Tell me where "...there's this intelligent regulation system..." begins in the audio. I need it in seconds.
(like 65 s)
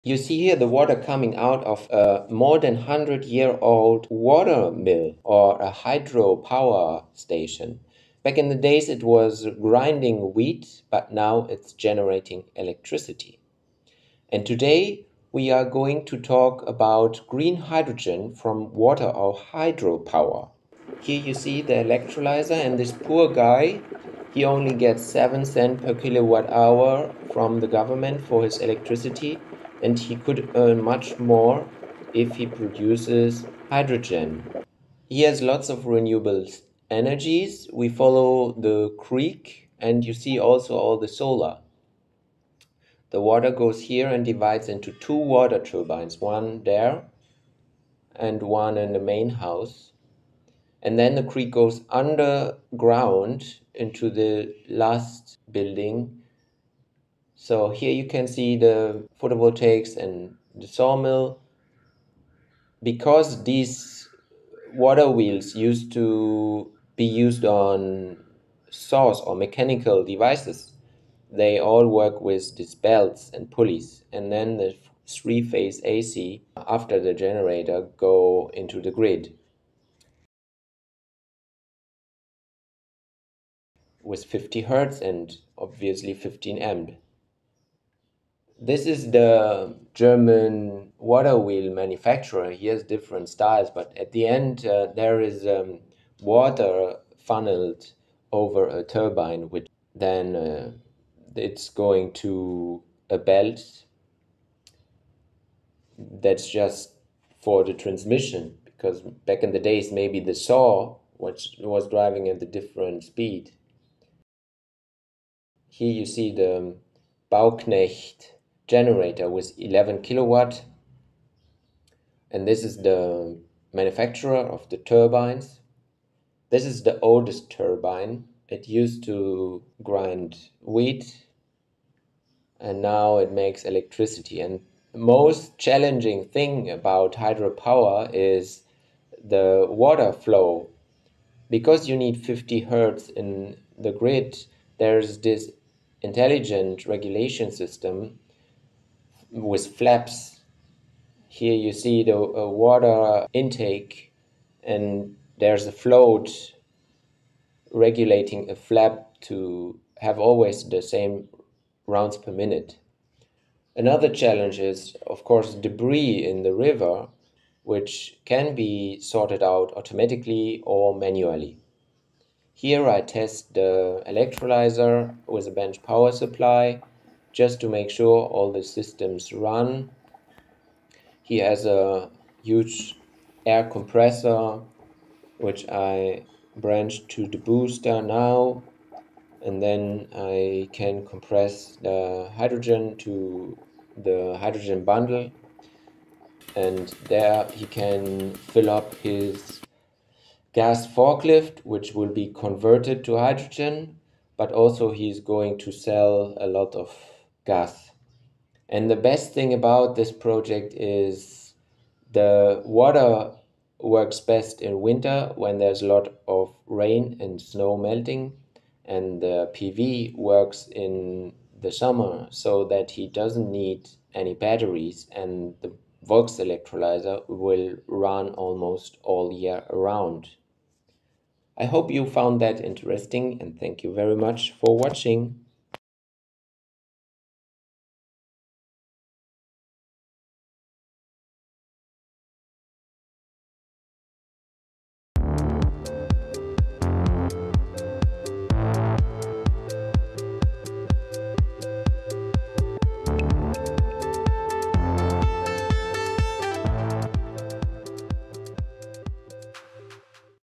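144 s.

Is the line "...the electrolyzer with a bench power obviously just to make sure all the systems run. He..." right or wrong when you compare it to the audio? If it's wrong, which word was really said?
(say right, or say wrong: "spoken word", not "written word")
wrong: "supply", not "obviously".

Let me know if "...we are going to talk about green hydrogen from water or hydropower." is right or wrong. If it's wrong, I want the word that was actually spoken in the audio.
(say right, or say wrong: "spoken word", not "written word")
right.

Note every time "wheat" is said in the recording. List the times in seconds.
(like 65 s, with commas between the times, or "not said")
10 s, 130 s.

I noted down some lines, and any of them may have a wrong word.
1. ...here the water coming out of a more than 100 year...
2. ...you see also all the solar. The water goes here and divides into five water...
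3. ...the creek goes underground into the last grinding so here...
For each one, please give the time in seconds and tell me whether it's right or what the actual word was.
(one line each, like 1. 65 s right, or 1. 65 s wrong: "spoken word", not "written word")
1. 0 s right
2. 40 s wrong: "two", not "five"
3. 51 s wrong: "building", not "grinding".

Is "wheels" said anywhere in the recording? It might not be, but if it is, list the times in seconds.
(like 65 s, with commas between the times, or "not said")
65 s, 91 s.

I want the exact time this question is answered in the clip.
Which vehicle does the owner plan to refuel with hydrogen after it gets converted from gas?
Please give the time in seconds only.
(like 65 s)
200 s.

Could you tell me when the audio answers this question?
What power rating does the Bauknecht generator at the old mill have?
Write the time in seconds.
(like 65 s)
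119 s.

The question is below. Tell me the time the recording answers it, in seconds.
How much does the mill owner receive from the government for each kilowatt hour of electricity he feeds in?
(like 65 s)
25 s.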